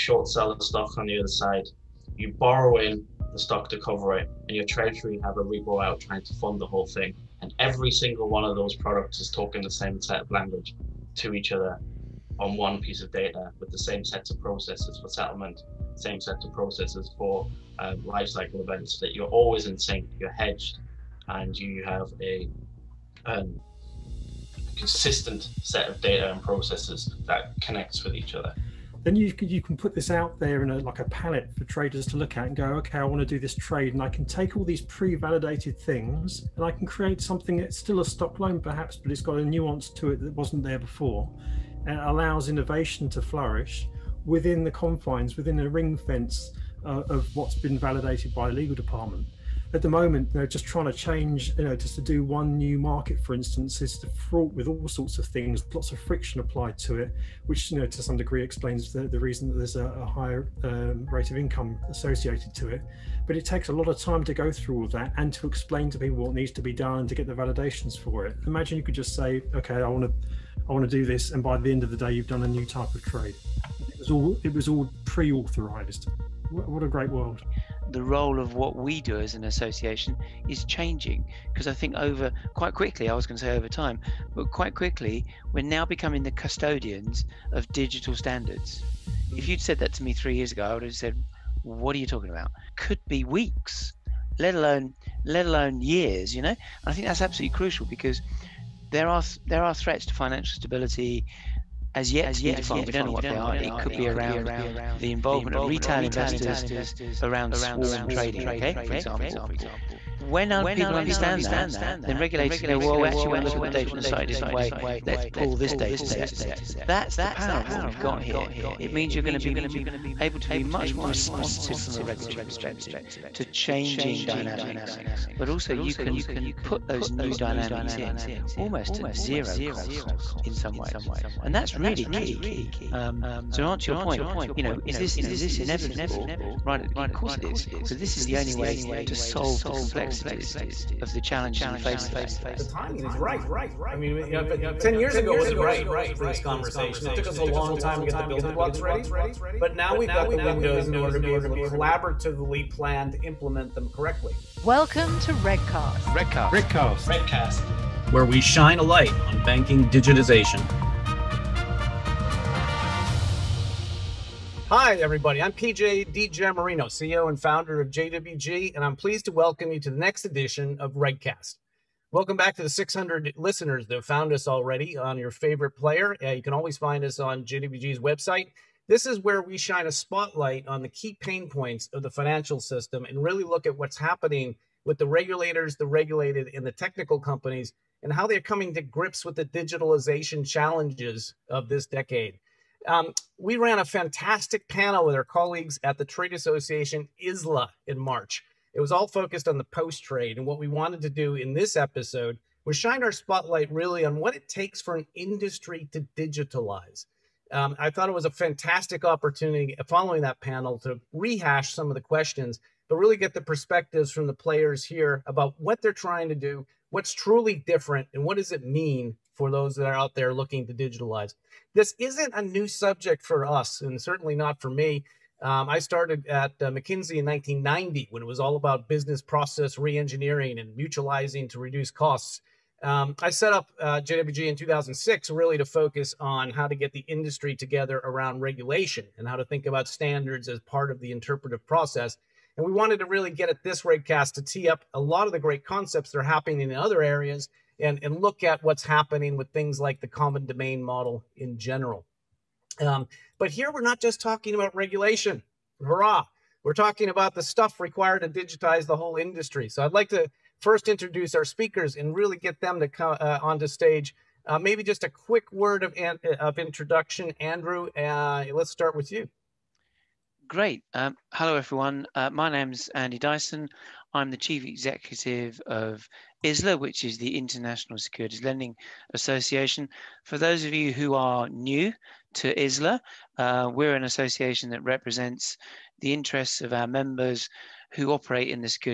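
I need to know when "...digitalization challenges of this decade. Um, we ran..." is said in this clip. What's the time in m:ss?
3:09.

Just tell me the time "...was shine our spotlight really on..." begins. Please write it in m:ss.
3:22.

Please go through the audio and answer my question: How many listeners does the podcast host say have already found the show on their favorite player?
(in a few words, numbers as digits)
600.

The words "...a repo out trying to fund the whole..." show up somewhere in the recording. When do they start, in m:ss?
0:05.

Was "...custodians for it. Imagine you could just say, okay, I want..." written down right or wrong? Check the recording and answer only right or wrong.
wrong.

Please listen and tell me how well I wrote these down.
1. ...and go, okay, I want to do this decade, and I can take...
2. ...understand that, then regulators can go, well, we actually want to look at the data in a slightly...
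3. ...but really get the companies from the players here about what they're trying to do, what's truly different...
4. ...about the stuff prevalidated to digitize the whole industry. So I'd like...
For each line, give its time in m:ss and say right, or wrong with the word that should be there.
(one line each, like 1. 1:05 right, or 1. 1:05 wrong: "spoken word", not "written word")
1. 0:32 wrong: "trade", not "decade"
2. 1:50 right
3. 3:32 wrong: "perspectives", not "companies"
4. 4:17 wrong: "required", not "prevalidated".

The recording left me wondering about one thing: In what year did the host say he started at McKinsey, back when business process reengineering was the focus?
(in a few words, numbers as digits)
1990.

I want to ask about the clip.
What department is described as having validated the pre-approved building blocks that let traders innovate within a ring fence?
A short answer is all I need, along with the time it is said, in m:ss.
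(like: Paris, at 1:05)
Legal department, at 0:48.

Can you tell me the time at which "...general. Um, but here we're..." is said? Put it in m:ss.
4:11.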